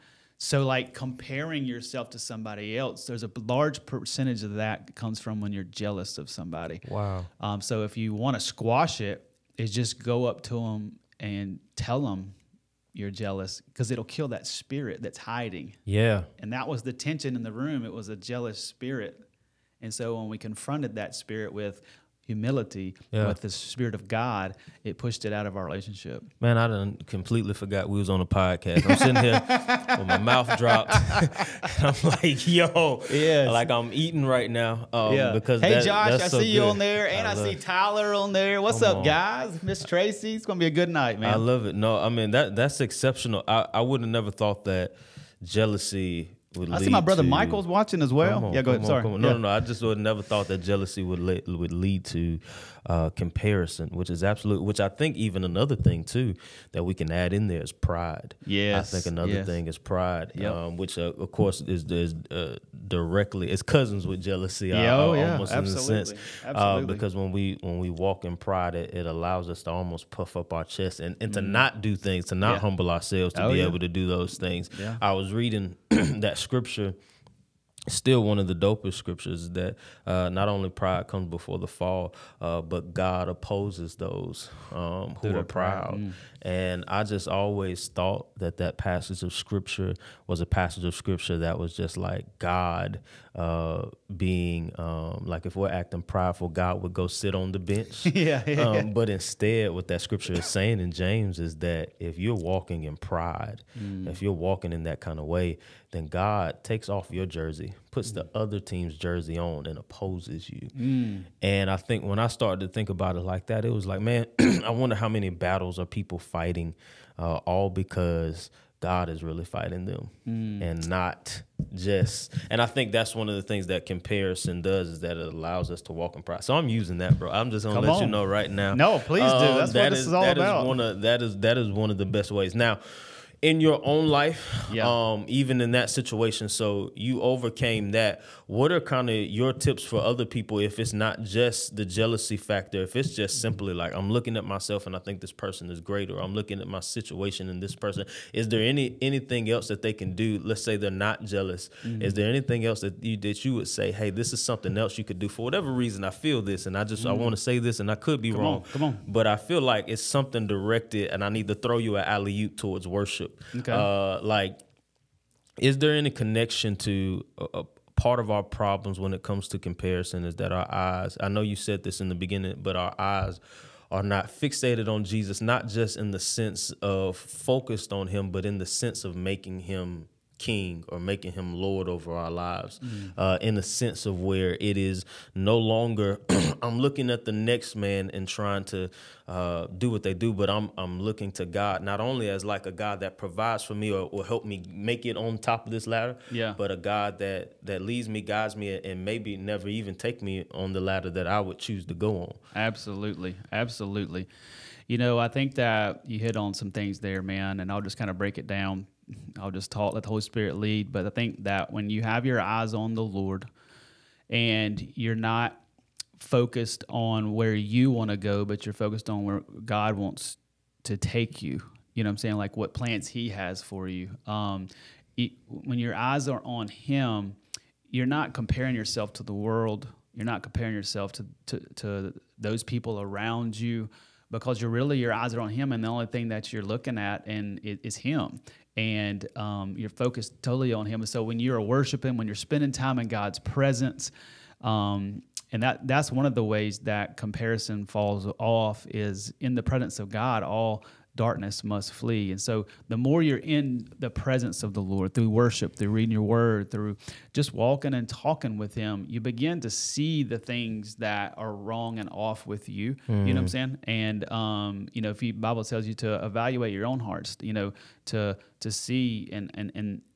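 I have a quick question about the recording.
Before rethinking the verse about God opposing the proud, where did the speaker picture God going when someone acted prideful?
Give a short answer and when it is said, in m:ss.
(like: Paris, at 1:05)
The bench, at 1:37.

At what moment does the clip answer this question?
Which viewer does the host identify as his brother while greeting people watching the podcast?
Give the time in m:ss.
0:47.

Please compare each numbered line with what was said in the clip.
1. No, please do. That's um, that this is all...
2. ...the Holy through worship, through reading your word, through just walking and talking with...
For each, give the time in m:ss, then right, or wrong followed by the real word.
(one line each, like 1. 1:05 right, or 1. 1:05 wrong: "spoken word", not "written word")
1. 2:08 right
2. 4:14 wrong: "Lord", not "Holy".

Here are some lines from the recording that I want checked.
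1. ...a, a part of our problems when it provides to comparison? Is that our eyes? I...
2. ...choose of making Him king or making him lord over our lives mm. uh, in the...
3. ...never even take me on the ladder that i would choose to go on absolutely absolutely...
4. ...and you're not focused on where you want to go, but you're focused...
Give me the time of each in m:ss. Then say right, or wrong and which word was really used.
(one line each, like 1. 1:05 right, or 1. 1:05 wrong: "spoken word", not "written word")
1. 2:47 wrong: "comes", not "provides"
2. 2:58 wrong: "sense", not "choose"
3. 3:19 right
4. 3:34 right.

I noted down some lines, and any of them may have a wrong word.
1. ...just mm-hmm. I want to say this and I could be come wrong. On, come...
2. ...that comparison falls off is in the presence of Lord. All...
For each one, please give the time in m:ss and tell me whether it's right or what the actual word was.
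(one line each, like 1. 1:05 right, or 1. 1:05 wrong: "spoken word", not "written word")
1. 2:36 right
2. 4:06 wrong: "God", not "Lord".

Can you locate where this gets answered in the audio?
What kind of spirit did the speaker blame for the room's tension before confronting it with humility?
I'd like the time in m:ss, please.
0:18.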